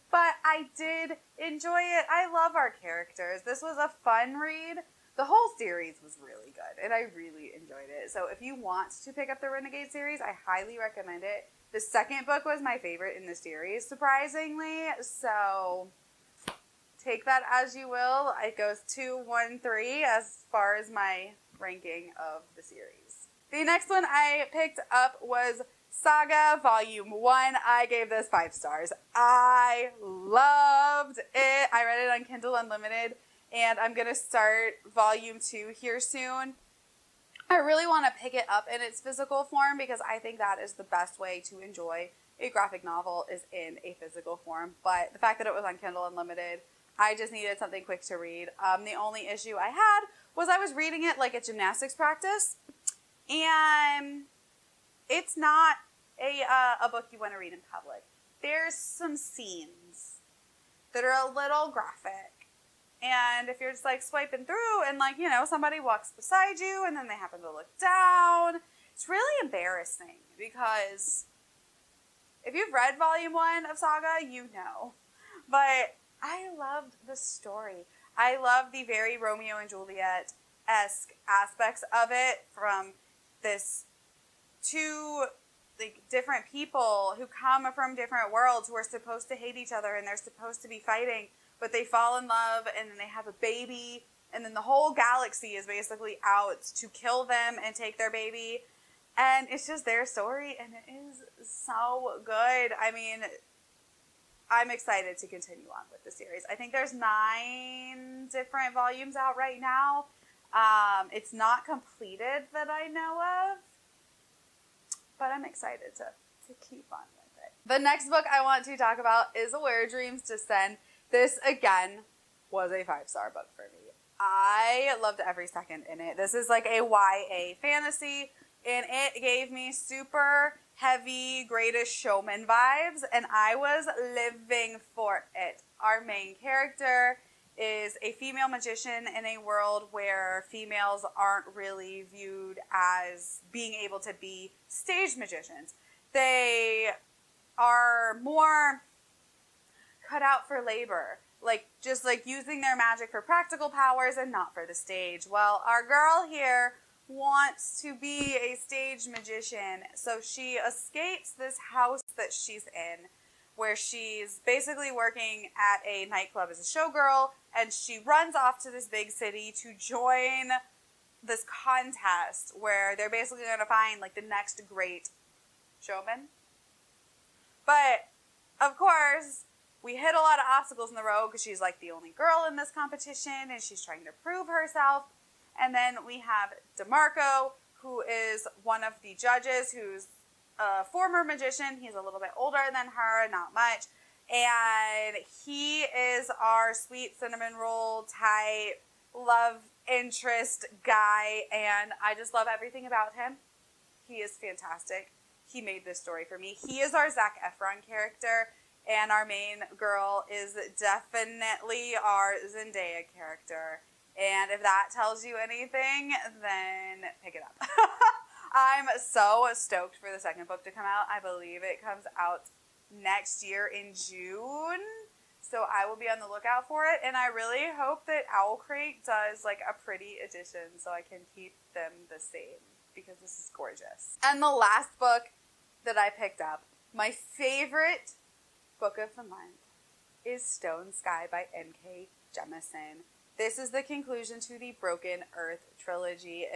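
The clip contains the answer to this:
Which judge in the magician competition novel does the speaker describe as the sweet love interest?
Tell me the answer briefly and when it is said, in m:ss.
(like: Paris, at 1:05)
DeMarco, at 3:06.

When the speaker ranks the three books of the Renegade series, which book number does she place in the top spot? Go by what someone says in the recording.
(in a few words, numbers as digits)
2.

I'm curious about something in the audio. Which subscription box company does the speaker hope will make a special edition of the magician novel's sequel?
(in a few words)
Owl Crate.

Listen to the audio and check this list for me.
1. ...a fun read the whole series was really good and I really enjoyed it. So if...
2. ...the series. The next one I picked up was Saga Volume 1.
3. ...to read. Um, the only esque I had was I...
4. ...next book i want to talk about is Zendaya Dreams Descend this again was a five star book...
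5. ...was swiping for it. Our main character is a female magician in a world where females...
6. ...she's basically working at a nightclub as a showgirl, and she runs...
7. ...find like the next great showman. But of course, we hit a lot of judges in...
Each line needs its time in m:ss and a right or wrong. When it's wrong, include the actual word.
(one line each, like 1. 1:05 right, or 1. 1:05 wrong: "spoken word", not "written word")
1. 0:03 right
2. 0:22 right
3. 0:48 wrong: "issue", not "esque"
4. 1:57 wrong: "Where", not "Zendaya"
5. 2:13 wrong: "living", not "swiping"
6. 2:43 right
7. 2:53 wrong: "obstacles", not "judges".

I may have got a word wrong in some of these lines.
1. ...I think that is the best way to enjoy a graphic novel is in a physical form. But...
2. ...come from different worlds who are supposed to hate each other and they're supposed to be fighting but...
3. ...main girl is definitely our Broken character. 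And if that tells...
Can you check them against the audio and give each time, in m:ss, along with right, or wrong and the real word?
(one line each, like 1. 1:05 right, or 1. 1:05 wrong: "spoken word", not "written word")
1. 0:40 right
2. 1:27 right
3. 3:29 wrong: "Zendaya", not "Broken".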